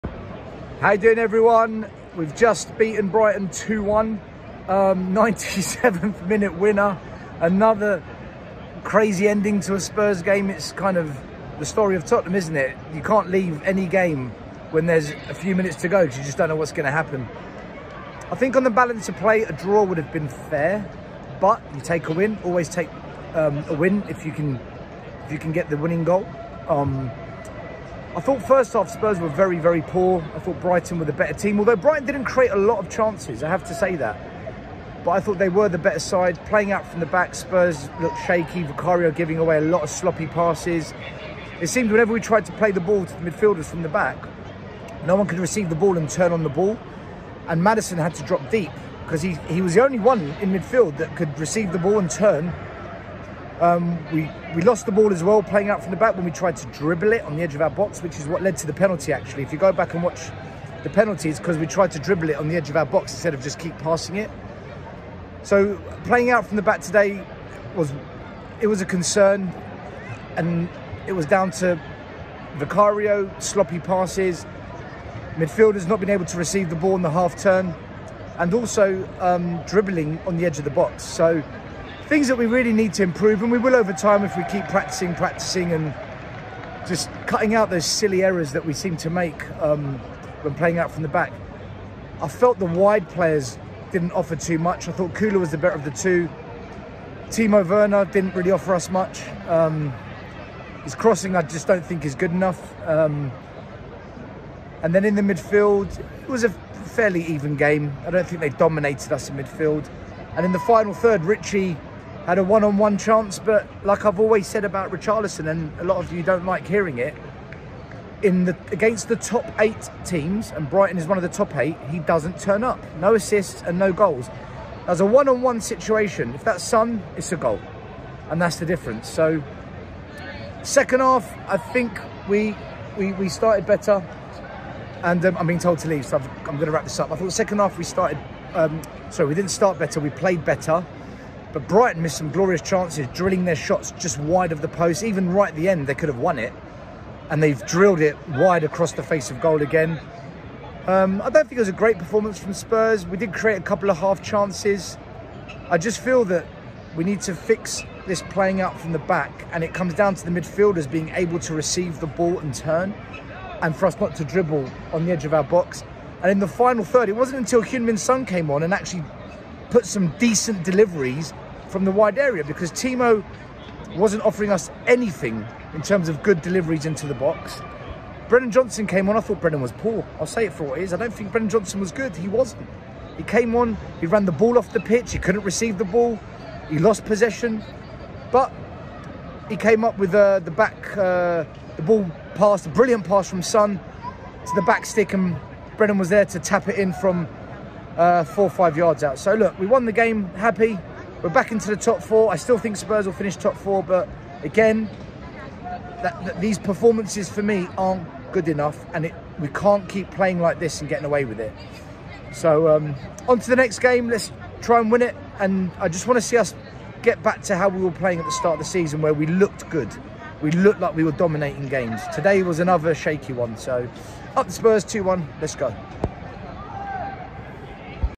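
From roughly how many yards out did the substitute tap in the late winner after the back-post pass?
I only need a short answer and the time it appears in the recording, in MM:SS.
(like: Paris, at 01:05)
4 or 5 yards, at 03:18.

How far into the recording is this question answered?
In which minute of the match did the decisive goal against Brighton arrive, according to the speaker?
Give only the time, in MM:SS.
00:05.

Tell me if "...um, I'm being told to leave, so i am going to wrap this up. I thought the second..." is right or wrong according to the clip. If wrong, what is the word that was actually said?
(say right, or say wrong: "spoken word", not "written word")
right.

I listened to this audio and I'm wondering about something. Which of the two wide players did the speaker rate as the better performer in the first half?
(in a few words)
Kula.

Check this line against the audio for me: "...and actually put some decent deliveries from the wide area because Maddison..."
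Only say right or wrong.
wrong.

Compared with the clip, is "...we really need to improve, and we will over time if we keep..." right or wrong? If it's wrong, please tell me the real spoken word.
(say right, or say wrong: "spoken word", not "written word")
right.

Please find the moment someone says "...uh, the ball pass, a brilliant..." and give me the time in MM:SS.
03:10.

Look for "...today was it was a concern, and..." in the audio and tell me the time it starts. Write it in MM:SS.
01:06.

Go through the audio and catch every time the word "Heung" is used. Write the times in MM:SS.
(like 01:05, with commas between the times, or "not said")
02:47.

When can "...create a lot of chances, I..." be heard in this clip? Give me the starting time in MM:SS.
00:32.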